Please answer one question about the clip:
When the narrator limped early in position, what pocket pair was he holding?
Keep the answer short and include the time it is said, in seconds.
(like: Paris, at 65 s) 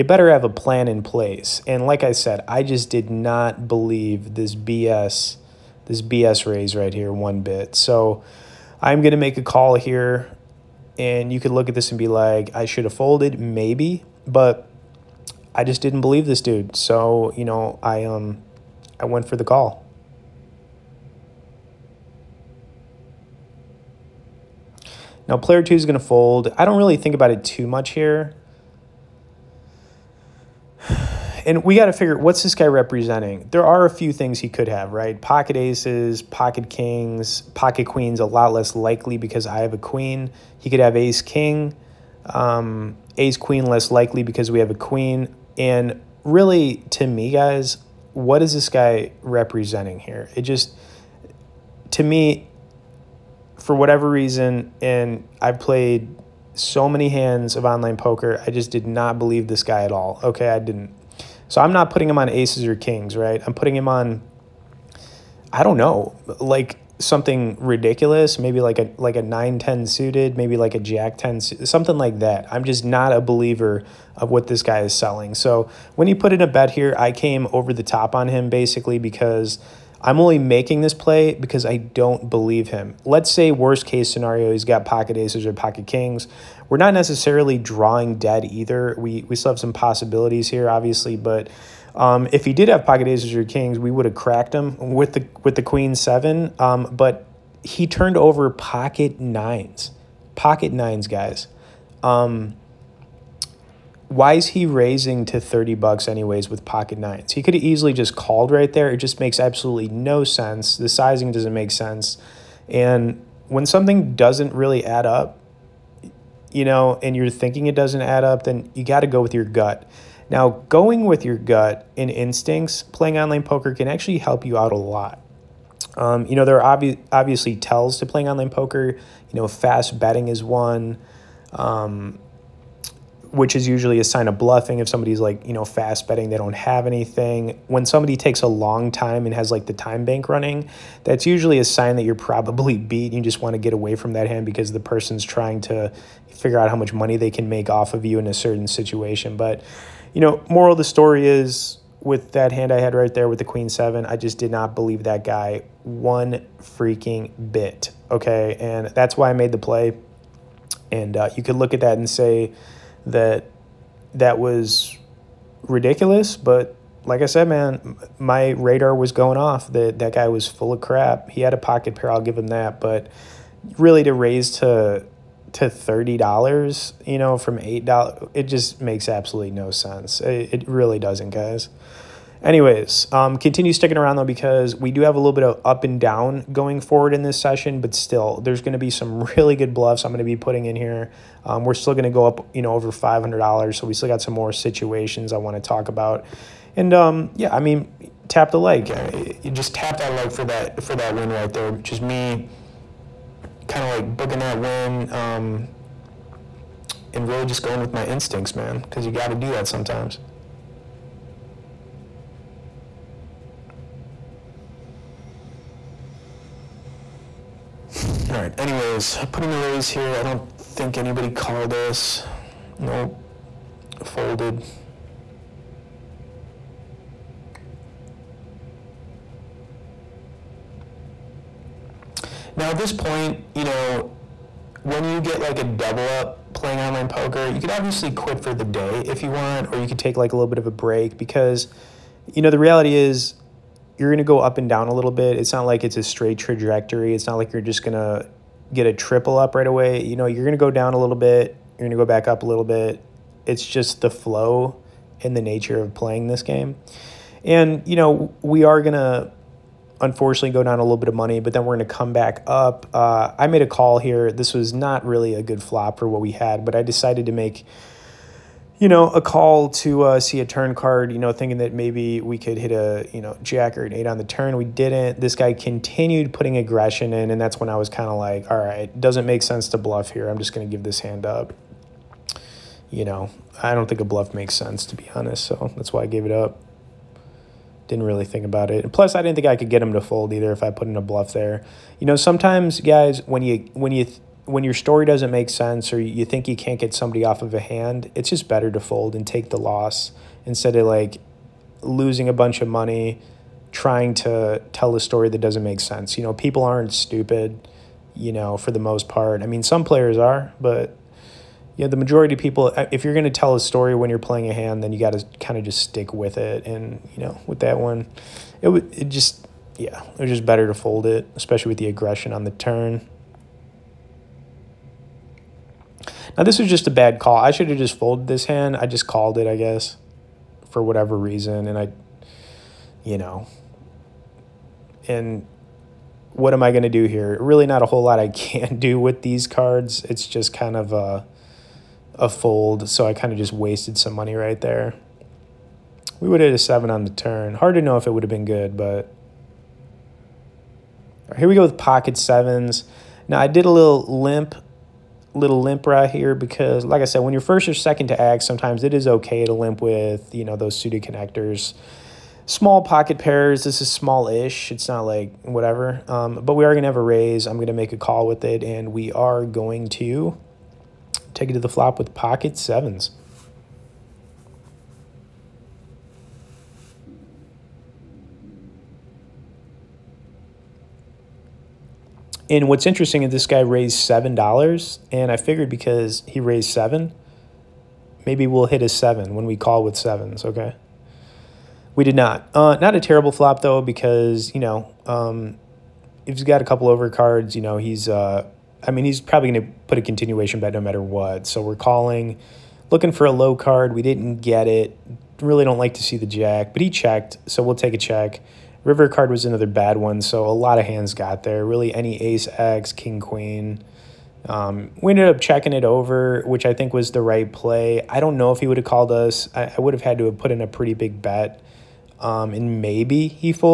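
Pocket 7s, at 351 s.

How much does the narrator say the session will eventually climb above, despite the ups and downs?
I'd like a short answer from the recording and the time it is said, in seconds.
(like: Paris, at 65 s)
500 dollars, at 192 s.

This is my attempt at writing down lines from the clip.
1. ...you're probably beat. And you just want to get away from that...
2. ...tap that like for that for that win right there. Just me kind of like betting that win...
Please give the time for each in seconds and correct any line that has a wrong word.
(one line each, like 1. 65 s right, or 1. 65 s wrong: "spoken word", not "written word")
1. 142 s right
2. 199 s wrong: "booking", not "betting".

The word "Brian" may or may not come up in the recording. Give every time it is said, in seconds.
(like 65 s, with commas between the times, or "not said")
not said.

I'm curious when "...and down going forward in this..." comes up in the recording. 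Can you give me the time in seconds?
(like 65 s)
185 s.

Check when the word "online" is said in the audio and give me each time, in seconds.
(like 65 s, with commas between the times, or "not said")
57 s, 123 s, 128 s, 236 s.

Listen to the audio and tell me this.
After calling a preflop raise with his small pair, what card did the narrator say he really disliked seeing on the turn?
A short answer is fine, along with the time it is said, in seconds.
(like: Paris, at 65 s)
The jack, at 406 s.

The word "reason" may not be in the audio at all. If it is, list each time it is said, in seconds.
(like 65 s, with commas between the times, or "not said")
54 s, 331 s.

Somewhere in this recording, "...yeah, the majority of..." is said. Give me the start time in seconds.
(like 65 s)
311 s.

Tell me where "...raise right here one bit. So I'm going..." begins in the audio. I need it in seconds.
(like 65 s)
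6 s.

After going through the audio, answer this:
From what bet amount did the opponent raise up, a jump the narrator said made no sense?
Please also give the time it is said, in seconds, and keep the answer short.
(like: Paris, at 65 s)
$8, at 177 s.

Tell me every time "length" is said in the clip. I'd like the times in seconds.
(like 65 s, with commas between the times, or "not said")
not said.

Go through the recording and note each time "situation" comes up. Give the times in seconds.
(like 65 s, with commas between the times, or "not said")
148 s, 194 s.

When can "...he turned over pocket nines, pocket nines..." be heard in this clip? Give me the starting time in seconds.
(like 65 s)
97 s.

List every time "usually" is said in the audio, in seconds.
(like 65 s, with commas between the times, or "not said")
133 s, 141 s.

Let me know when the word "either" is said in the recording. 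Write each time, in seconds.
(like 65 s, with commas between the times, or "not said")
88 s, 290 s.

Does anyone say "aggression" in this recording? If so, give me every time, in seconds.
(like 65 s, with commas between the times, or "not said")
276 s, 321 s.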